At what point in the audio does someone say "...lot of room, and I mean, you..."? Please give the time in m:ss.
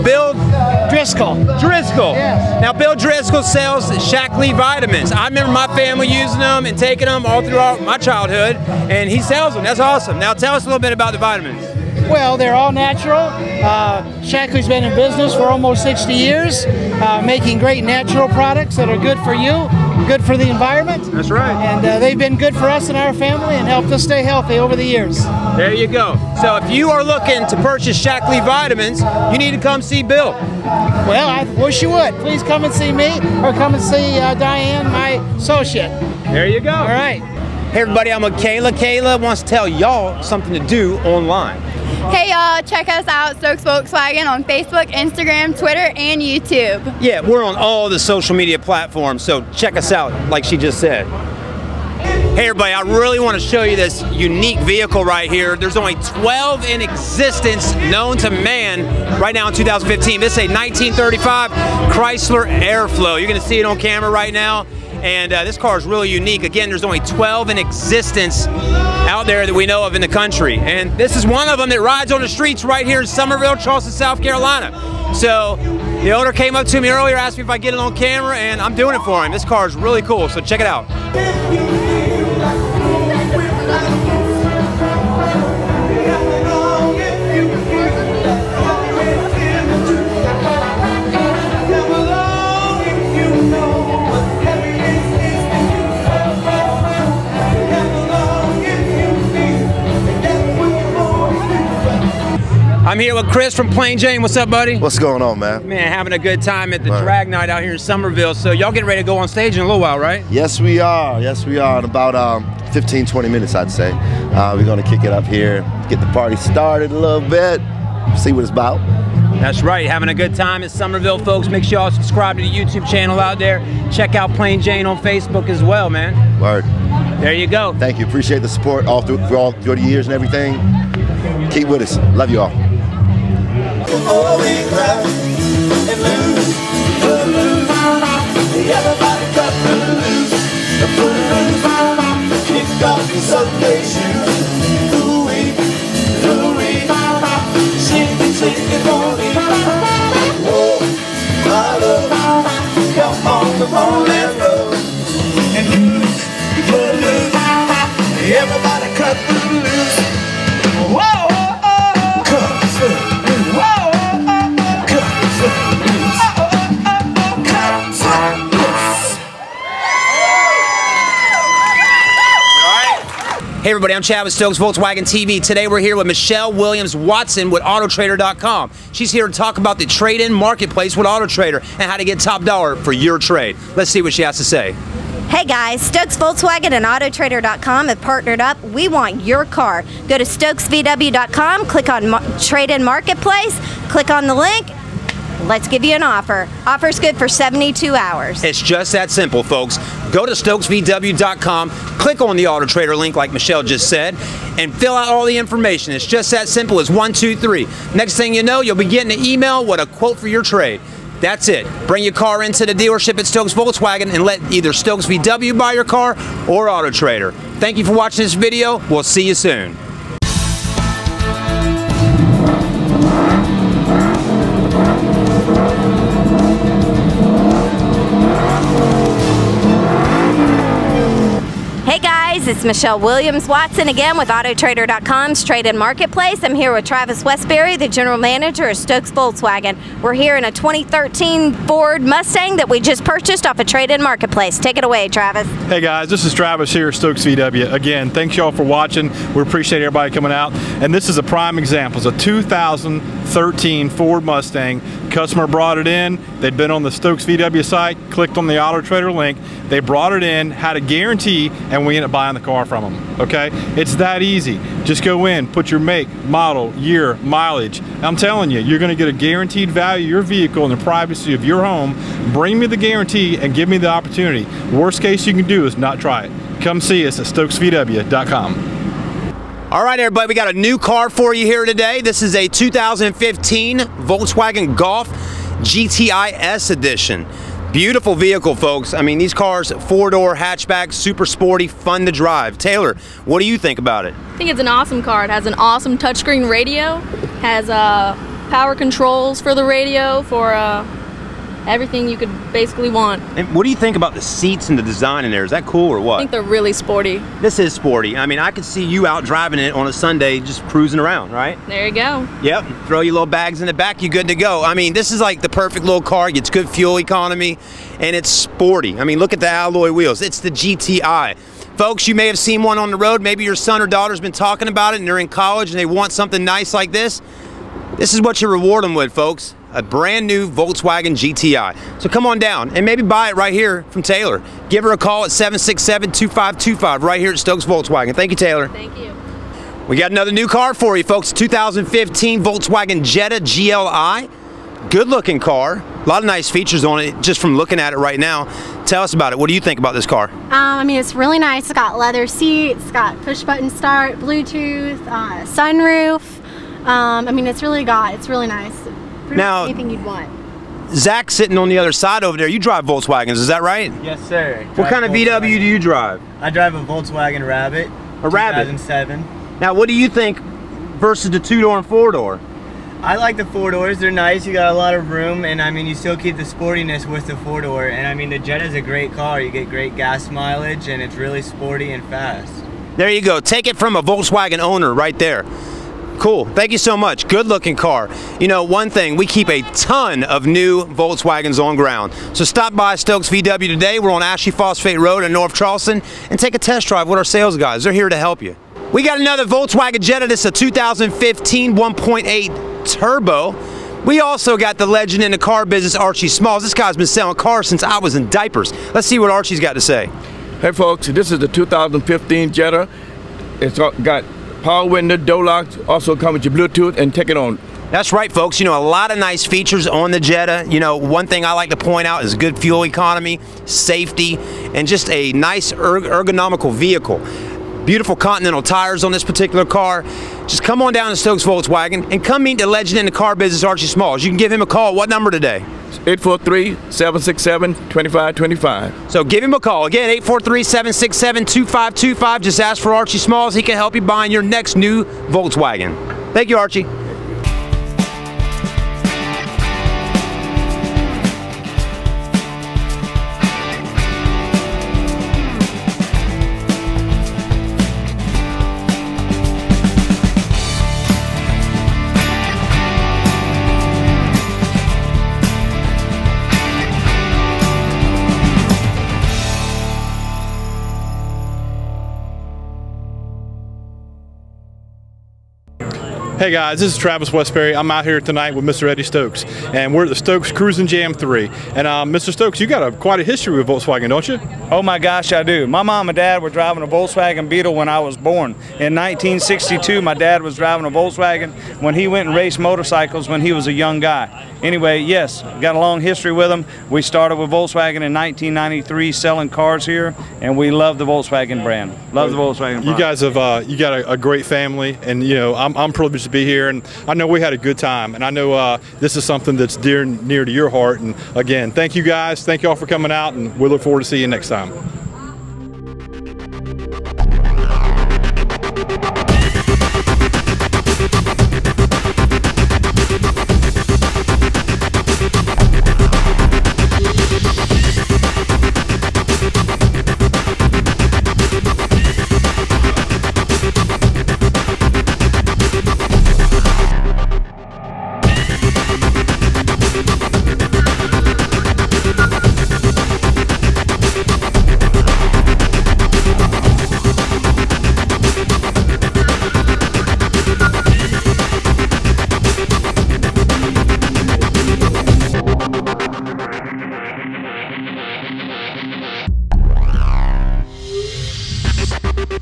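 6:14.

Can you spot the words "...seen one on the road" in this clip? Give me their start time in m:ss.
5:22.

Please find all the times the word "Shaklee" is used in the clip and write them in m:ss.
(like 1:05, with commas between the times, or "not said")
0:04, 0:14, 0:28.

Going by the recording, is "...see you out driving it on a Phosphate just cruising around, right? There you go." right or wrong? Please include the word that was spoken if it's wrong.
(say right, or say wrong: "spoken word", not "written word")
wrong: "Sunday", not "Phosphate".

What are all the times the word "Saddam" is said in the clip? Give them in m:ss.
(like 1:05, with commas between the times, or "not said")
not said.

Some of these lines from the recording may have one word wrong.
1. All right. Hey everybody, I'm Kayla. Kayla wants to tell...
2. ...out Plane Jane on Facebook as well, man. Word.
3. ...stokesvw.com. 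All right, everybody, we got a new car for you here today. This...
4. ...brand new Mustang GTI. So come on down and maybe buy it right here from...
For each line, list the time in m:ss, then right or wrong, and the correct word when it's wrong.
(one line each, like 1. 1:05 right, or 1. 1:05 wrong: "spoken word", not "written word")
1. 0:36 right
2. 2:04 right
3. 4:37 right
4. 5:29 wrong: "Volkswagen", not "Mustang".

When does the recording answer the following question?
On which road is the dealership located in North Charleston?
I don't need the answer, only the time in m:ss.
6:34.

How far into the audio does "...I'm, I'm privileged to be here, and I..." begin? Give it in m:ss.
8:25.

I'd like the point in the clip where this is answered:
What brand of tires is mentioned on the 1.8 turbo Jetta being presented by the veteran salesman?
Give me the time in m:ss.
7:08.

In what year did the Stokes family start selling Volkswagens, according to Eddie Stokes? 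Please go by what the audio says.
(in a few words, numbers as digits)
1993.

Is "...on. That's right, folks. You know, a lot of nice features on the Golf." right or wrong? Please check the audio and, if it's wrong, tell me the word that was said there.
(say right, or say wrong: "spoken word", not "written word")
wrong: "Jetta", not "Golf".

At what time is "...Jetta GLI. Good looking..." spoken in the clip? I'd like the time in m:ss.
5:43.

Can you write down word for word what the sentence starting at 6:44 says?
We also got the legend in the car business, Archie Smalls.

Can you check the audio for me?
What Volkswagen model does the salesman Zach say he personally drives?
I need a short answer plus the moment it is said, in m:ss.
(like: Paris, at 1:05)
Volkswagen Rabbit, at 6:06.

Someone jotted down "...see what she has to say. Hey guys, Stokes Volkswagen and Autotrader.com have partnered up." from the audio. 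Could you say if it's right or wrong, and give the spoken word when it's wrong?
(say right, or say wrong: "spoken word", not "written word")
right.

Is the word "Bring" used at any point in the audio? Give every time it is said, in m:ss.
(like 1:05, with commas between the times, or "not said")
3:31, 4:32.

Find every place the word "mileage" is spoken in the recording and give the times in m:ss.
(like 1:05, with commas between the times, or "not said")
4:27, 6:20.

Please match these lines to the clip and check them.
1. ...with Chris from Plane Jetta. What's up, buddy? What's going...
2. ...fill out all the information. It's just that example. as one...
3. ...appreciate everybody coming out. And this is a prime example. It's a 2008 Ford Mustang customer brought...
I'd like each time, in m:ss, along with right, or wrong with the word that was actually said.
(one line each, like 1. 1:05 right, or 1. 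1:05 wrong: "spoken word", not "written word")
1. 1:43 wrong: "Jane", not "Jetta"
2. 3:24 wrong: "simple", not "example"
3. 4:09 wrong: "2013", not "2008".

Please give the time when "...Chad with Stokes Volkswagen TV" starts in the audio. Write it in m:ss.
2:54.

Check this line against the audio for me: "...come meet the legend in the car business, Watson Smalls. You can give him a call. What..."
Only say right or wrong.
wrong.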